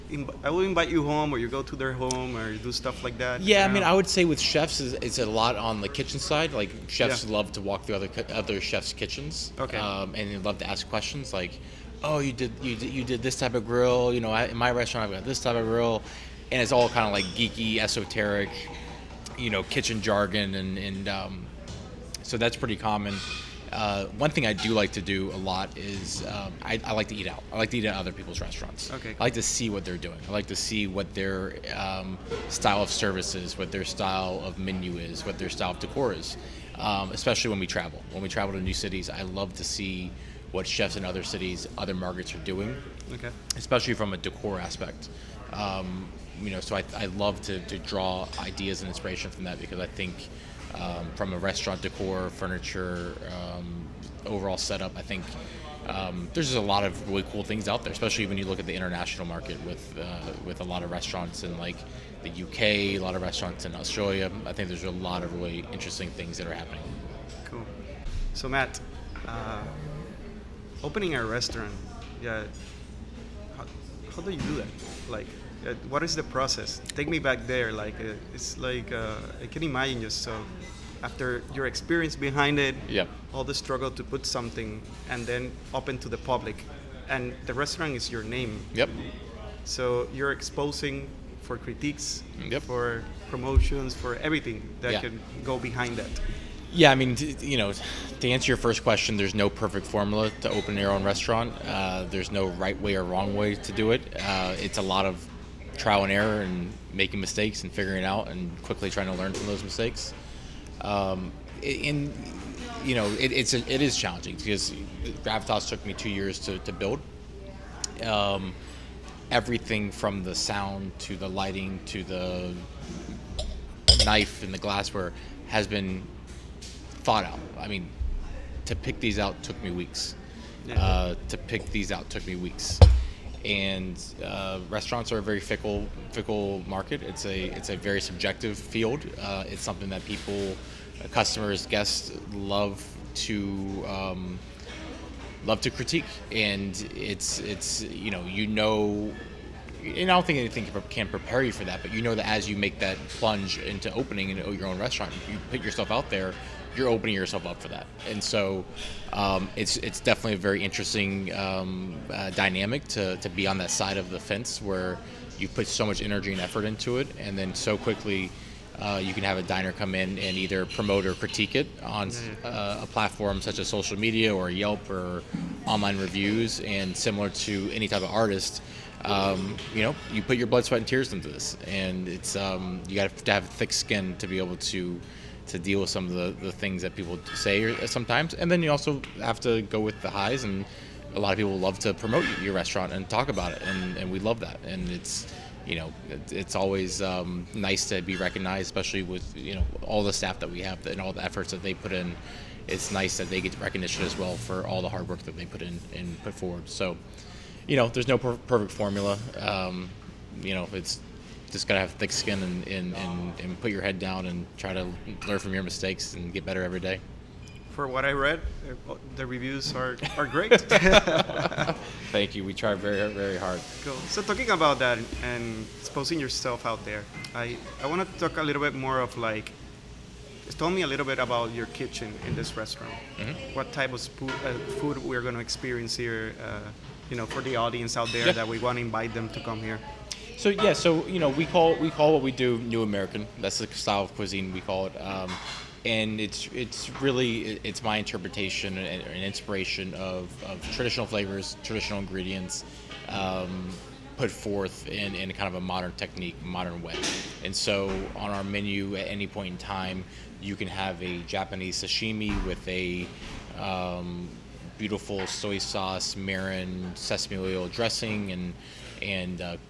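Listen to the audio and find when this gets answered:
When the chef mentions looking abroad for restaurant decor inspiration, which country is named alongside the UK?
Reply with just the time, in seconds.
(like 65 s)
63 s.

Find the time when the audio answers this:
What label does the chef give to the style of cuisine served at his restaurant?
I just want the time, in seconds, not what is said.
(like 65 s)
242 s.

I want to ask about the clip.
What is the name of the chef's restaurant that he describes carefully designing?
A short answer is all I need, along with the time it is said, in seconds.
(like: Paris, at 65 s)
Gravitas, at 115 s.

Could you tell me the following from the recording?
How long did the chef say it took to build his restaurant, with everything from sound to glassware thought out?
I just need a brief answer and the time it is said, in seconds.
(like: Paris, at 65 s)
2 years, at 115 s.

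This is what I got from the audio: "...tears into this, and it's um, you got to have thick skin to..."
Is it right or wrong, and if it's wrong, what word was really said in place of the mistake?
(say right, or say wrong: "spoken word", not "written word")
right.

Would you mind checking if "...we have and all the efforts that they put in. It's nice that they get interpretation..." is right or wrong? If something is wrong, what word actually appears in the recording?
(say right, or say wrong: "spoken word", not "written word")
wrong: "recognition", not "interpretation".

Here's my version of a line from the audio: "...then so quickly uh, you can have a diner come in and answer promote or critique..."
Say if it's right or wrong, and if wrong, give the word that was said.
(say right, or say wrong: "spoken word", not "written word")
wrong: "either", not "answer".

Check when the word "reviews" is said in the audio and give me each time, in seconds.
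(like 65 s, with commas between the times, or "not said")
175 s, 219 s.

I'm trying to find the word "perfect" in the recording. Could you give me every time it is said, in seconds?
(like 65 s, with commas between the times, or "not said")
99 s, 208 s.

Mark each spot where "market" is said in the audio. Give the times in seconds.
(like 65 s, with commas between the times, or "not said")
41 s, 59 s, 136 s.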